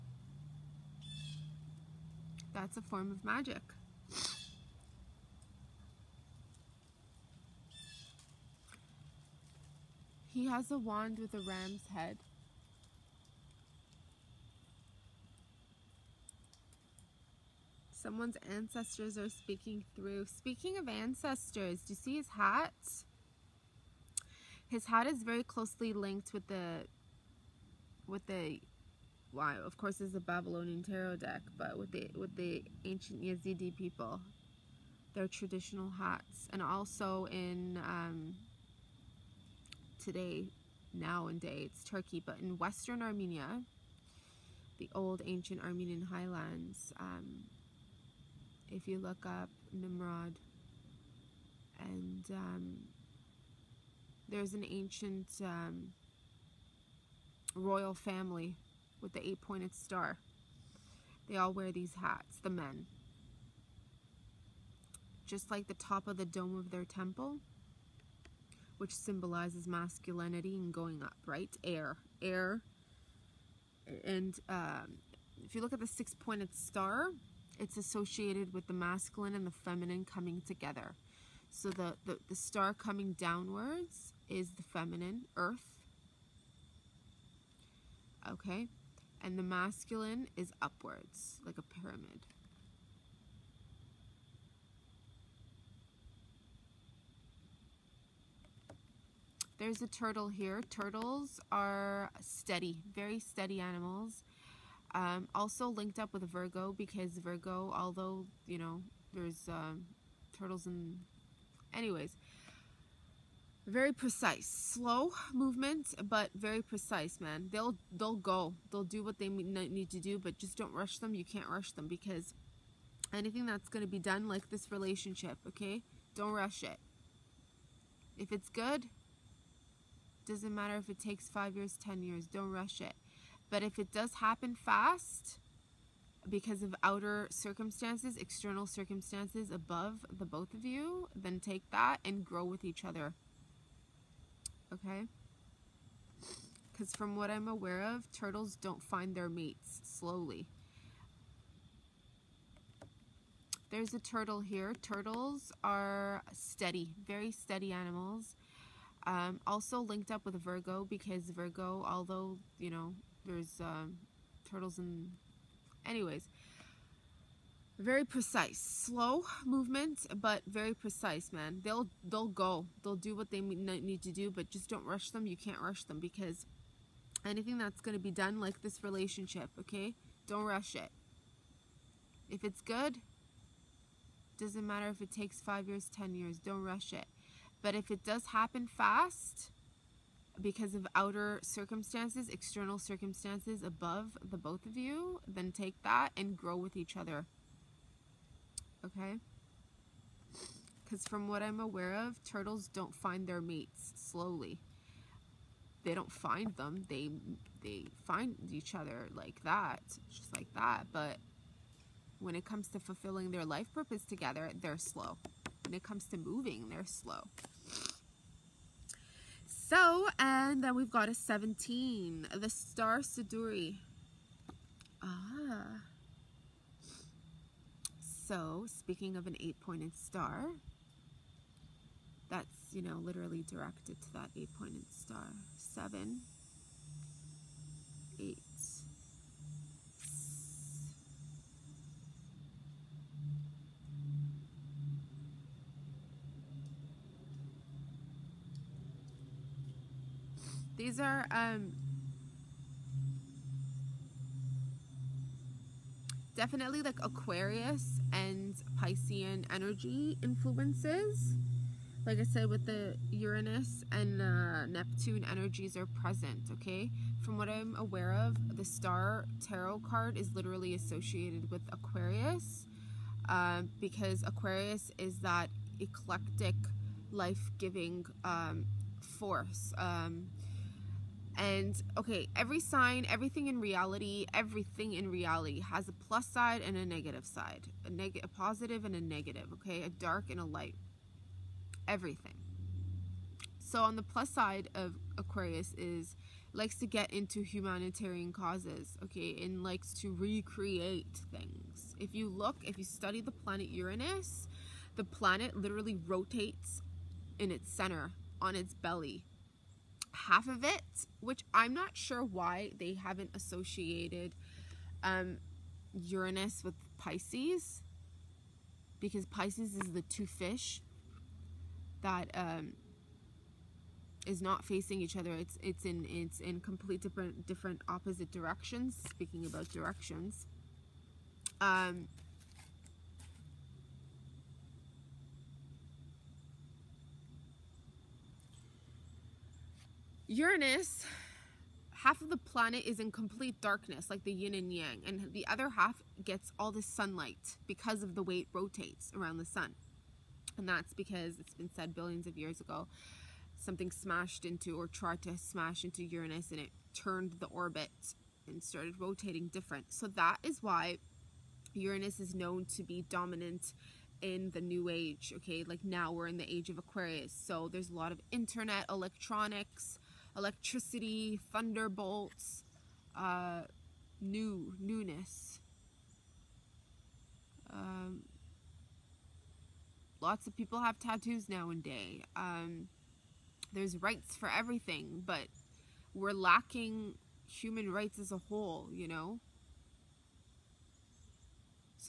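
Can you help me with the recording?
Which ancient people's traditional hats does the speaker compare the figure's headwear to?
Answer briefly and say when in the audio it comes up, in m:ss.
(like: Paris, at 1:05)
Yazidi, at 0:33.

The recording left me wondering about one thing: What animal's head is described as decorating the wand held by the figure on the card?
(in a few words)
Ram.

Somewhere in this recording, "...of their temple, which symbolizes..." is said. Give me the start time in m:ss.
1:06.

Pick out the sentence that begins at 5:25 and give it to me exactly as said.
It's it's in it's in complete different different opposite directions.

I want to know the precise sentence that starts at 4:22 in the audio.
Like I said, with the Uranus and uh, Neptune energies are present, okay?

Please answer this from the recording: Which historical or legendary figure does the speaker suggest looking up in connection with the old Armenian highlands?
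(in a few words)
Nimrod.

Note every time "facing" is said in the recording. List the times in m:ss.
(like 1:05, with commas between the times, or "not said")
5:24.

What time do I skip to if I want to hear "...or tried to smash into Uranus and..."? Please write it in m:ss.
5:54.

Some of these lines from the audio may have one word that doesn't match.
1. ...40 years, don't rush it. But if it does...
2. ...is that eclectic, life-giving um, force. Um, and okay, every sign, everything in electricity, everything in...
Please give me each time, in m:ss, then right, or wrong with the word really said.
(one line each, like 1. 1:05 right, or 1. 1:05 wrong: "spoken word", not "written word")
1. 2:11 wrong: "10", not "40"
2. 4:34 wrong: "reality", not "electricity".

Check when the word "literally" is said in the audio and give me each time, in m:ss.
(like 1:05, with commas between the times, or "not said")
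3:53, 4:30, 5:05.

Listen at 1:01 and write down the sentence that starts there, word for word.
They all wear these hats, the men.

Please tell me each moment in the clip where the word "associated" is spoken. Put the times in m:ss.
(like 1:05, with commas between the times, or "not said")
1:17, 4:30, 5:13.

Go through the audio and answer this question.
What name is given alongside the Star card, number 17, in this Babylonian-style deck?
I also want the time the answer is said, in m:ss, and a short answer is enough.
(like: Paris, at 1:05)
Siduri, at 3:42.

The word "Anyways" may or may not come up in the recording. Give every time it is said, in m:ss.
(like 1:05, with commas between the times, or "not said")
1:51, 2:45.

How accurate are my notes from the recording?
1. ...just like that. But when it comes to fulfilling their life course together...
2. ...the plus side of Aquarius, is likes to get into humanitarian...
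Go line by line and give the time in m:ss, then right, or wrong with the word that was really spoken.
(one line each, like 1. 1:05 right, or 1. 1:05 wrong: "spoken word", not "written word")
1. 3:30 wrong: "purpose", not "course"
2. 4:53 right.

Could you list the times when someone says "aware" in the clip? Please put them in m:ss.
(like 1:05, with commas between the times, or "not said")
2:27, 3:21, 4:27.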